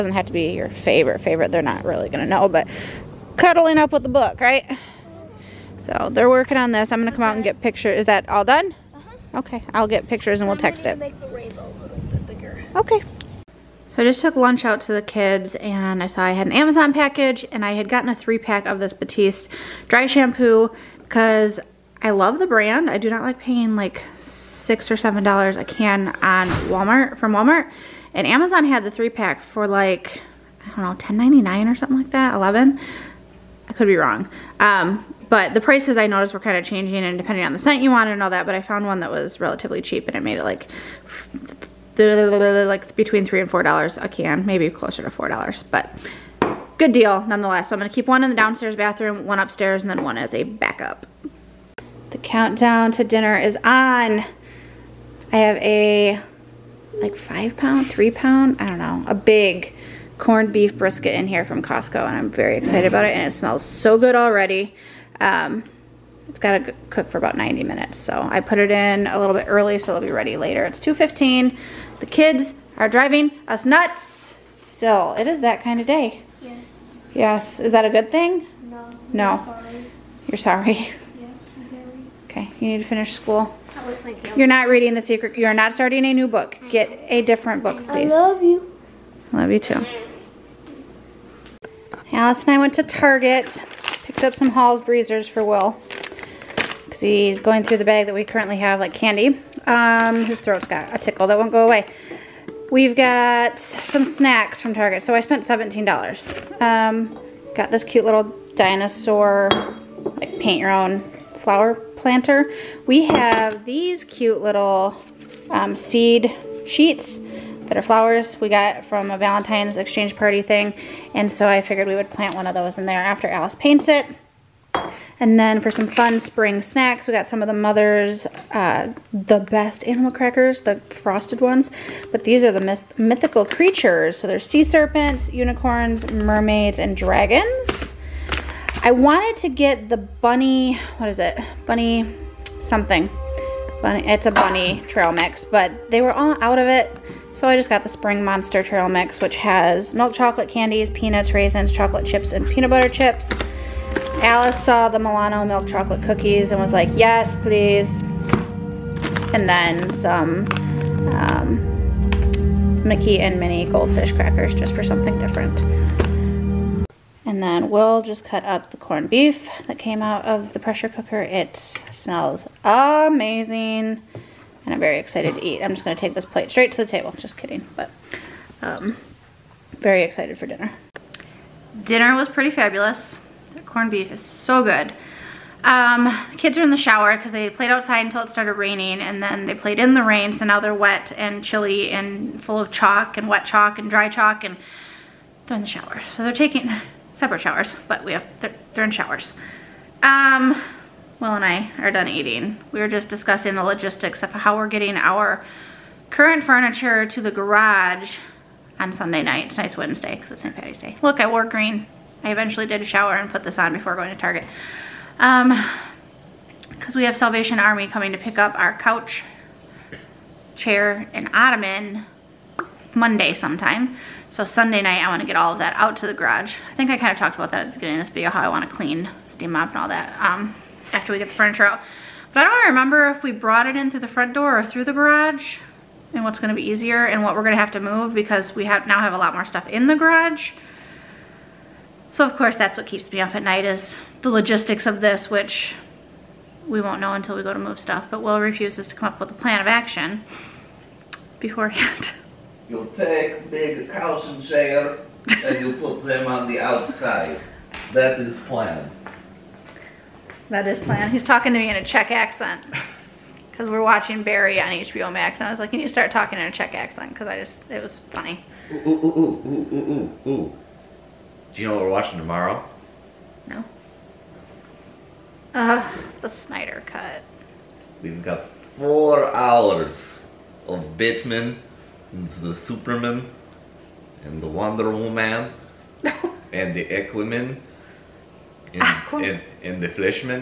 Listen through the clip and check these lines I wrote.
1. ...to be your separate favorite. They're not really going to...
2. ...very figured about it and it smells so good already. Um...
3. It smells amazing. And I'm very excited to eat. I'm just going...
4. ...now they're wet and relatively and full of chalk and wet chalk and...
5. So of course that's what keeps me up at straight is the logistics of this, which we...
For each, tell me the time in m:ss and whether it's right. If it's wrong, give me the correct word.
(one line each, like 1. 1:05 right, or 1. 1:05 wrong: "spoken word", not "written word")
1. 0:00 wrong: "favorite", not "separate"
2. 1:02 wrong: "excited", not "figured"
3. 2:51 right
4. 3:10 wrong: "chilly", not "relatively"
5. 4:02 wrong: "night", not "straight".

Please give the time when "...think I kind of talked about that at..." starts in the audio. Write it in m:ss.
3:46.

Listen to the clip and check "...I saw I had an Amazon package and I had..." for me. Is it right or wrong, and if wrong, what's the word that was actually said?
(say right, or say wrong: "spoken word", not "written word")
right.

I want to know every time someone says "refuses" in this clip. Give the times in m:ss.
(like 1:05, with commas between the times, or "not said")
4:08.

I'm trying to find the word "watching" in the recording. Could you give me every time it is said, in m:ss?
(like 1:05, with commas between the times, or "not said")
4:23, 4:31.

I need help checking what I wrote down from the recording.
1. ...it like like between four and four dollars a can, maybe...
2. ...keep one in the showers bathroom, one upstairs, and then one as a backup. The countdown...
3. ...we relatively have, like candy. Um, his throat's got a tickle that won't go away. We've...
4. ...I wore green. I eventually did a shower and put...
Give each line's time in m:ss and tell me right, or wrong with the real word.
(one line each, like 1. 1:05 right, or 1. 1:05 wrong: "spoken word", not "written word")
1. 0:40 wrong: "three", not "four"
2. 0:47 wrong: "downstairs", not "showers"
3. 1:38 wrong: "currently", not "relatively"
4. 3:31 right.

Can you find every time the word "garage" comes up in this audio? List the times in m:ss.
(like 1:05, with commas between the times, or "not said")
3:27, 3:46, 3:54, 3:59.